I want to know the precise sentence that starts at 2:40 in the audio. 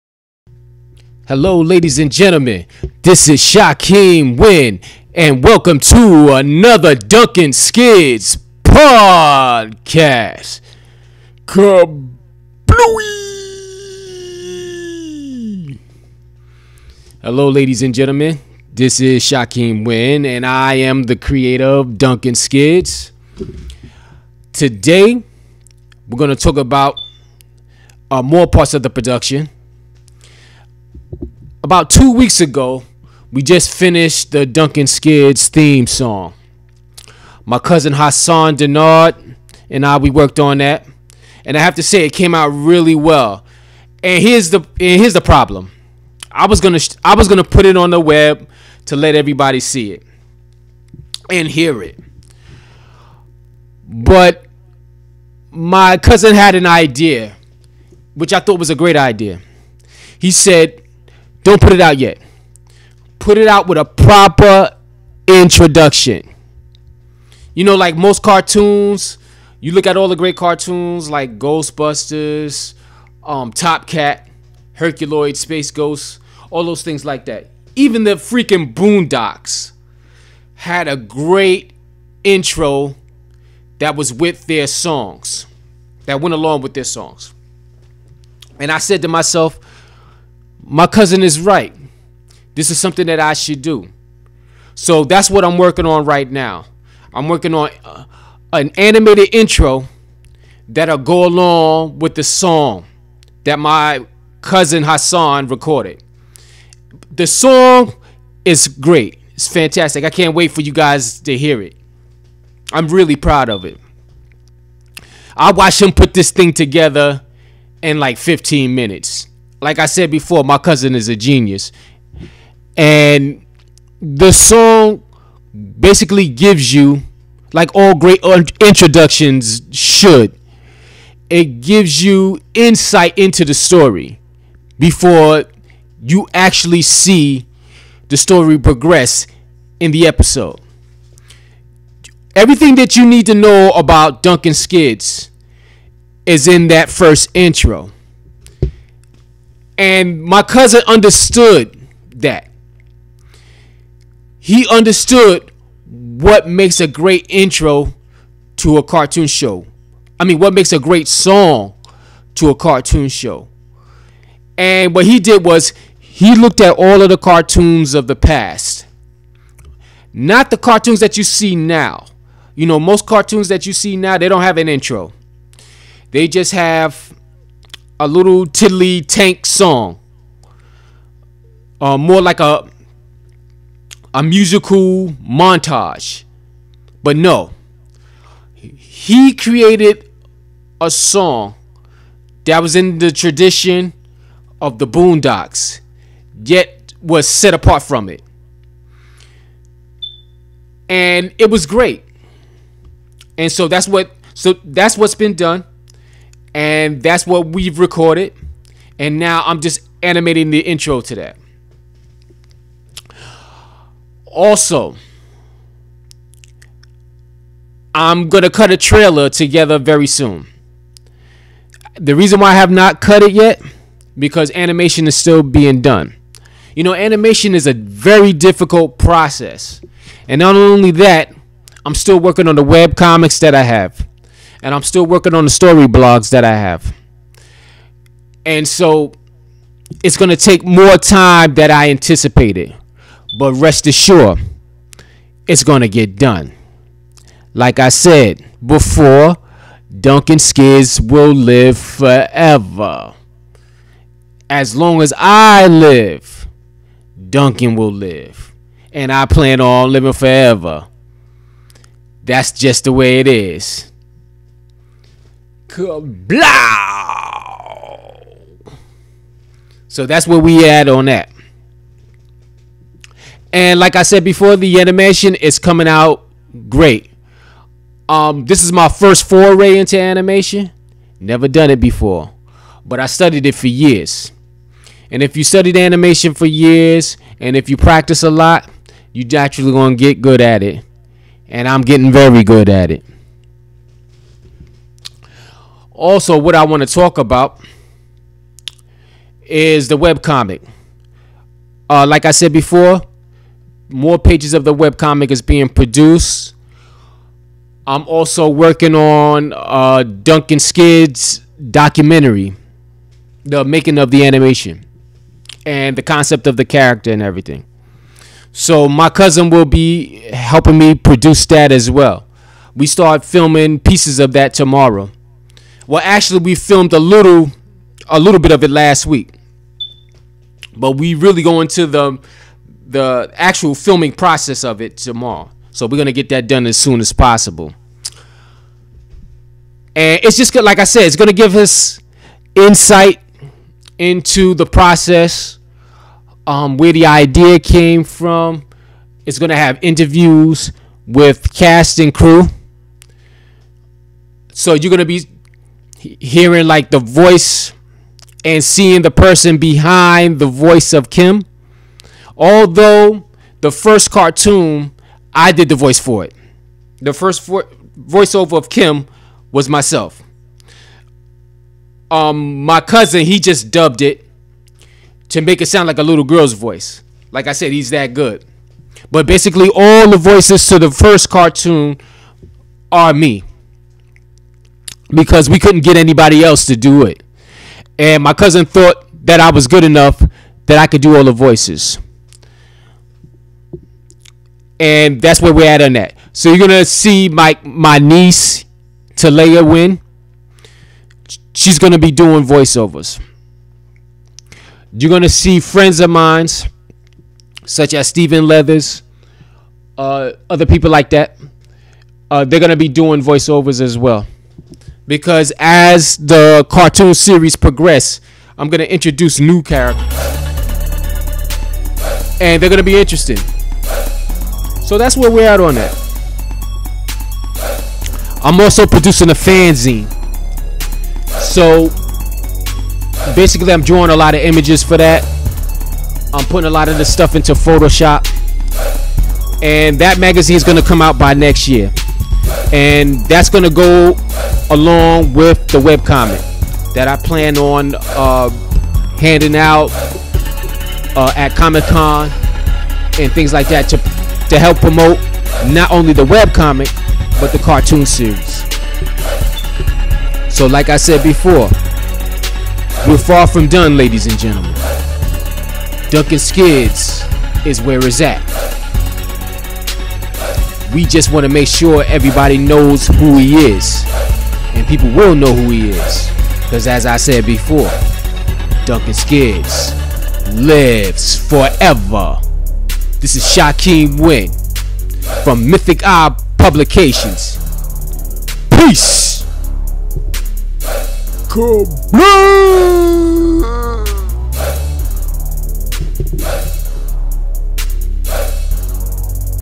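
I mean, what makes a great song to a cartoon show.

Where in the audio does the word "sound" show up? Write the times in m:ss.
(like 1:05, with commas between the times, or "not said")
6:15.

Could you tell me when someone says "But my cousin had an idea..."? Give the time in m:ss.
0:53.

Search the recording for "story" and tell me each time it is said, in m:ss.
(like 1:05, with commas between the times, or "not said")
2:13, 2:18, 3:55.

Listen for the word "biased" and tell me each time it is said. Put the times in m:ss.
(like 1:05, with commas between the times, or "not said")
not said.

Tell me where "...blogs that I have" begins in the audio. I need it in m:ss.
3:55.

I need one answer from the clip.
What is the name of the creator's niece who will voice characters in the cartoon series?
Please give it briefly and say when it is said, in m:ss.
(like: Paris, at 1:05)
Talia Winn, at 6:39.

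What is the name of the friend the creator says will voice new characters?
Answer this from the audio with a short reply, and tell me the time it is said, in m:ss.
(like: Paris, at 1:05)
Stephen Leathers, at 6:48.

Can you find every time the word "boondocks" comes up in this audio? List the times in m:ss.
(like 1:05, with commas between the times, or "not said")
1:18, 3:14.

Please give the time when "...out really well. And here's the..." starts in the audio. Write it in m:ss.
0:42.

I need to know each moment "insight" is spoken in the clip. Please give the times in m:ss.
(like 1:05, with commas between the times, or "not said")
2:12, 5:42.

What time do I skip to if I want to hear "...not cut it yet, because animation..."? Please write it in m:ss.
3:42.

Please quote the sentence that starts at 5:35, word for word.
So we're gonna get that done as soon as possible.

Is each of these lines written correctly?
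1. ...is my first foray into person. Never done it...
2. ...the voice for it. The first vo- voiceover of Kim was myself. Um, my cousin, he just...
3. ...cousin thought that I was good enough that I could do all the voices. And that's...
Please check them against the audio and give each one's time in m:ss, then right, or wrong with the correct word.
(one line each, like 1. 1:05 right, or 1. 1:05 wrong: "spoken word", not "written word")
1. 4:38 wrong: "animation", not "person"
2. 6:05 right
3. 6:28 right.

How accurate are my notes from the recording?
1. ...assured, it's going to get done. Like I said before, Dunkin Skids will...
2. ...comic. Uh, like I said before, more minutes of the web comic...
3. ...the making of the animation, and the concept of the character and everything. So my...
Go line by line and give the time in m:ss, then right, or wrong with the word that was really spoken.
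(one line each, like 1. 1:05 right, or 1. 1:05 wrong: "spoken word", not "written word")
1. 4:03 right
2. 5:00 wrong: "pages", not "minutes"
3. 5:13 right.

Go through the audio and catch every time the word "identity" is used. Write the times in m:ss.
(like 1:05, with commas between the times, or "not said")
not said.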